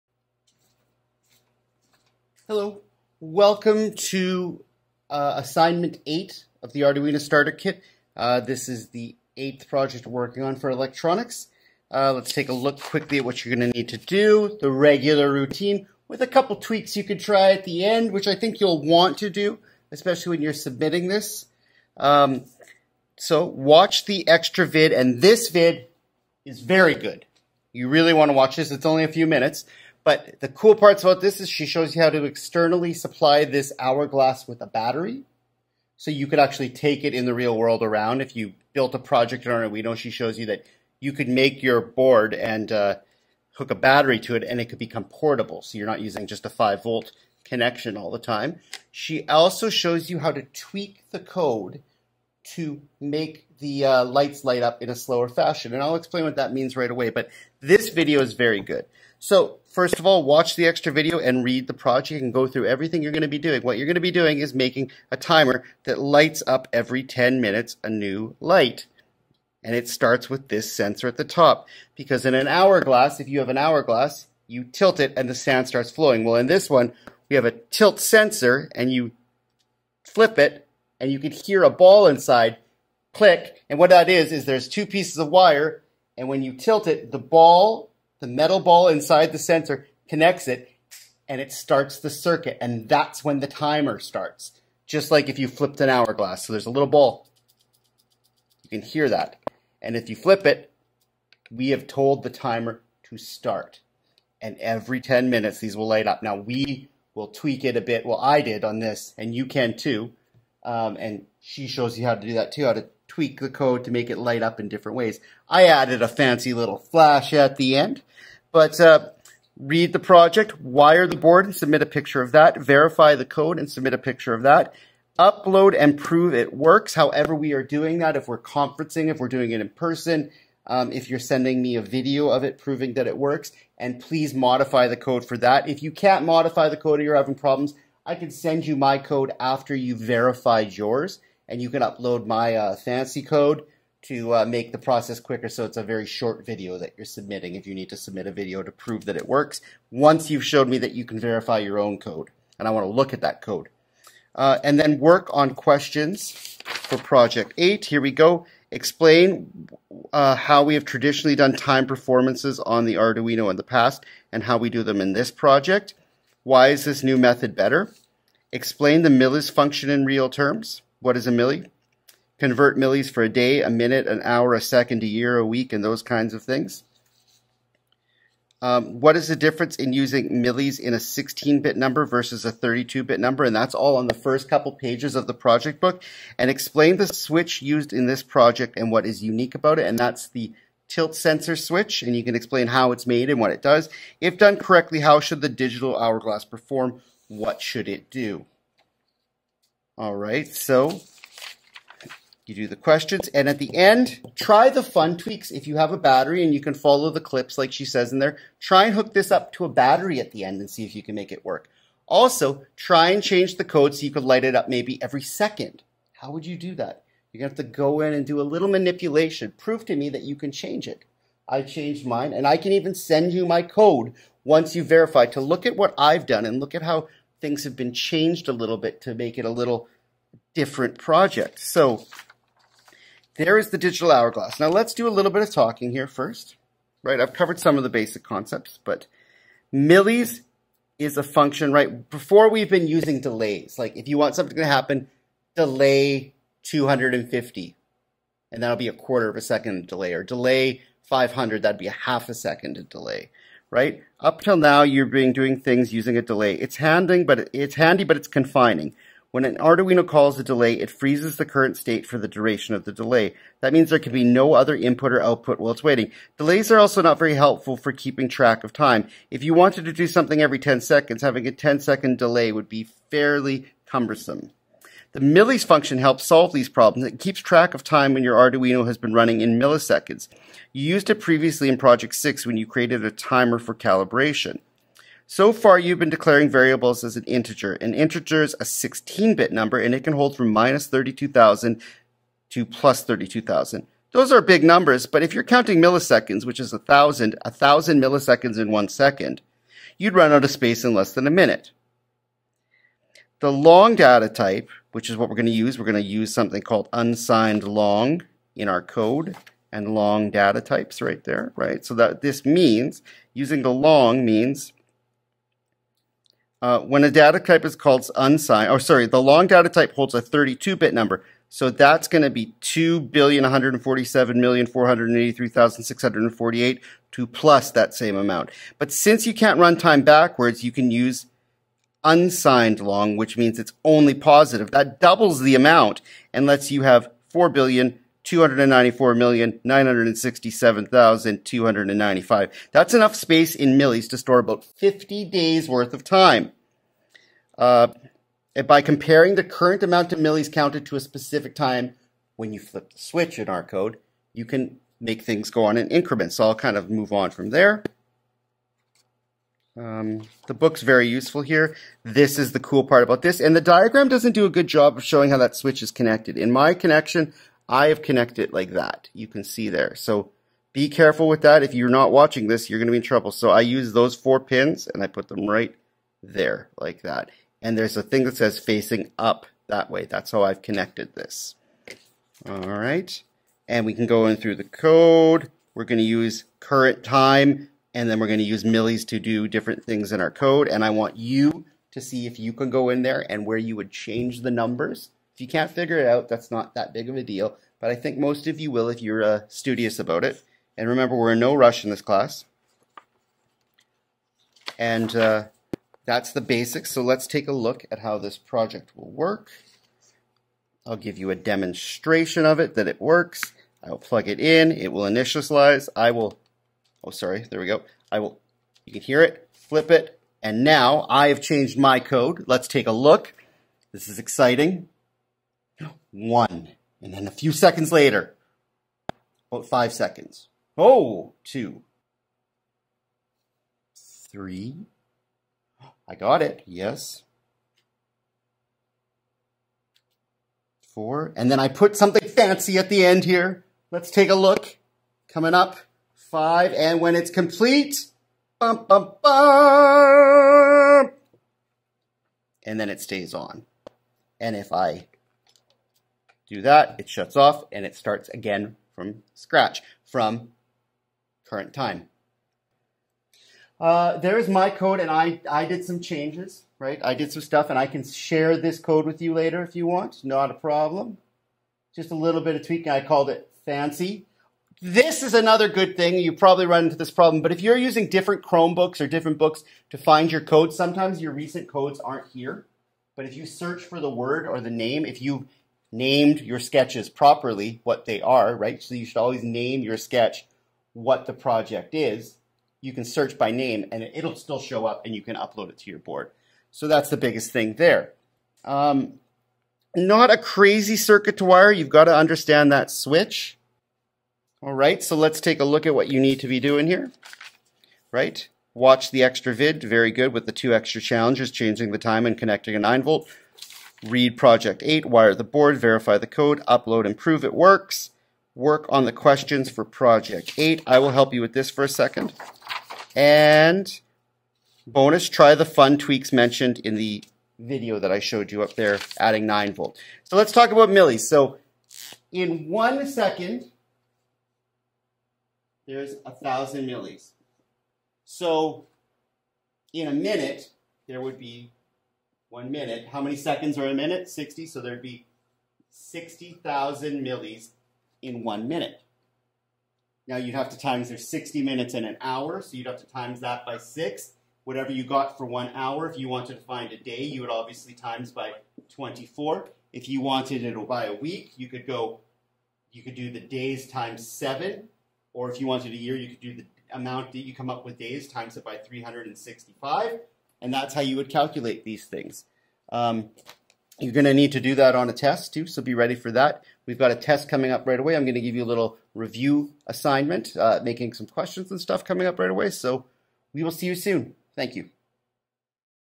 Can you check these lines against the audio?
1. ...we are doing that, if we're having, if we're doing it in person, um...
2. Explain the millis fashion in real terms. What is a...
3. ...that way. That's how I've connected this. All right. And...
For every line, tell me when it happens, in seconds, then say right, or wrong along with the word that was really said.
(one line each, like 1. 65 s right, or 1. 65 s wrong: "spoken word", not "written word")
1. 127 s wrong: "conferencing", not "having"
2. 168 s wrong: "function", not "fashion"
3. 379 s right.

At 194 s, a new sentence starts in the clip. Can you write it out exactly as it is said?
If done correctly, how should the digital hourglass perform?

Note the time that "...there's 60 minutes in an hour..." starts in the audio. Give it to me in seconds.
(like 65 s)
551 s.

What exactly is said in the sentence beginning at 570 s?
And that's how you would calculate these things.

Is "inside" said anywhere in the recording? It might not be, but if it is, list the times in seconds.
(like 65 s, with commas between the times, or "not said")
82 s, 88 s.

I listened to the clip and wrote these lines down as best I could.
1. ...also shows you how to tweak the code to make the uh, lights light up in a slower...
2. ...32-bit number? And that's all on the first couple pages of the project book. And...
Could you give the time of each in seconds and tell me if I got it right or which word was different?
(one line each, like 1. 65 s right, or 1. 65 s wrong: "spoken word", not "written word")
1. 49 s right
2. 182 s right.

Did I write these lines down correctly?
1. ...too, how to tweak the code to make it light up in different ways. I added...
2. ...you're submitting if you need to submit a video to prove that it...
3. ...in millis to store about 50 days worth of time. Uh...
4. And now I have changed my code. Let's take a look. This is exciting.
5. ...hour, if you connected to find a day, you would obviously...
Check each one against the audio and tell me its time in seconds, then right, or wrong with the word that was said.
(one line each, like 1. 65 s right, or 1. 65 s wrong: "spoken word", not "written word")
1. 112 s right
2. 146 s right
3. 339 s right
4. 420 s right
5. 555 s wrong: "wanted", not "connected".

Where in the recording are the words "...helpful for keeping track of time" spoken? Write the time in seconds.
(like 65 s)
267 s.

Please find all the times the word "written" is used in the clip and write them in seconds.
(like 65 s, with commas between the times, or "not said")
not said.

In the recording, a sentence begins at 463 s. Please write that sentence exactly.
Uh, there's my code, and I, I did some changes, right?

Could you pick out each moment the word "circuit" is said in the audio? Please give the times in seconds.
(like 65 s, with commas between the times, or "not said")
92 s, 500 s.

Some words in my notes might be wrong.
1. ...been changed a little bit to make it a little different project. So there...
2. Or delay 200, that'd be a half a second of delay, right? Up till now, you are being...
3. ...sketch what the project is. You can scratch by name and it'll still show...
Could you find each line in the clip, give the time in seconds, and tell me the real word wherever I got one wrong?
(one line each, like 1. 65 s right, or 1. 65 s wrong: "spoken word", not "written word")
1. 227 s right
2. 250 s wrong: "500", not "200"
3. 489 s wrong: "search", not "scratch".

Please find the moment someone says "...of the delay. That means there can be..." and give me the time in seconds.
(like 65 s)
262 s.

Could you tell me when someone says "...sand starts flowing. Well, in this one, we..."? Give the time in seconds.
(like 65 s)
75 s.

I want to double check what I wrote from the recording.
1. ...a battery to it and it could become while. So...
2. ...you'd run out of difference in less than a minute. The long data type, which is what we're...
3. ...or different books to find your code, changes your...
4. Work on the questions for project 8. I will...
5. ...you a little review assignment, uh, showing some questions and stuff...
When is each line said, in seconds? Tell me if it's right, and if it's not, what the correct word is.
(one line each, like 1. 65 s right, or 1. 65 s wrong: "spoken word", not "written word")
1. 43 s wrong: "portable", not "while"
2. 299 s wrong: "space", not "difference"
3. 478 s wrong: "sometimes", not "changes"
4. 518 s right
5. 578 s wrong: "making", not "showing".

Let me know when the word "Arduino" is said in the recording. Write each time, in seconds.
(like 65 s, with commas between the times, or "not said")
6 s, 39 s, 162 s, 259 s, 278 s.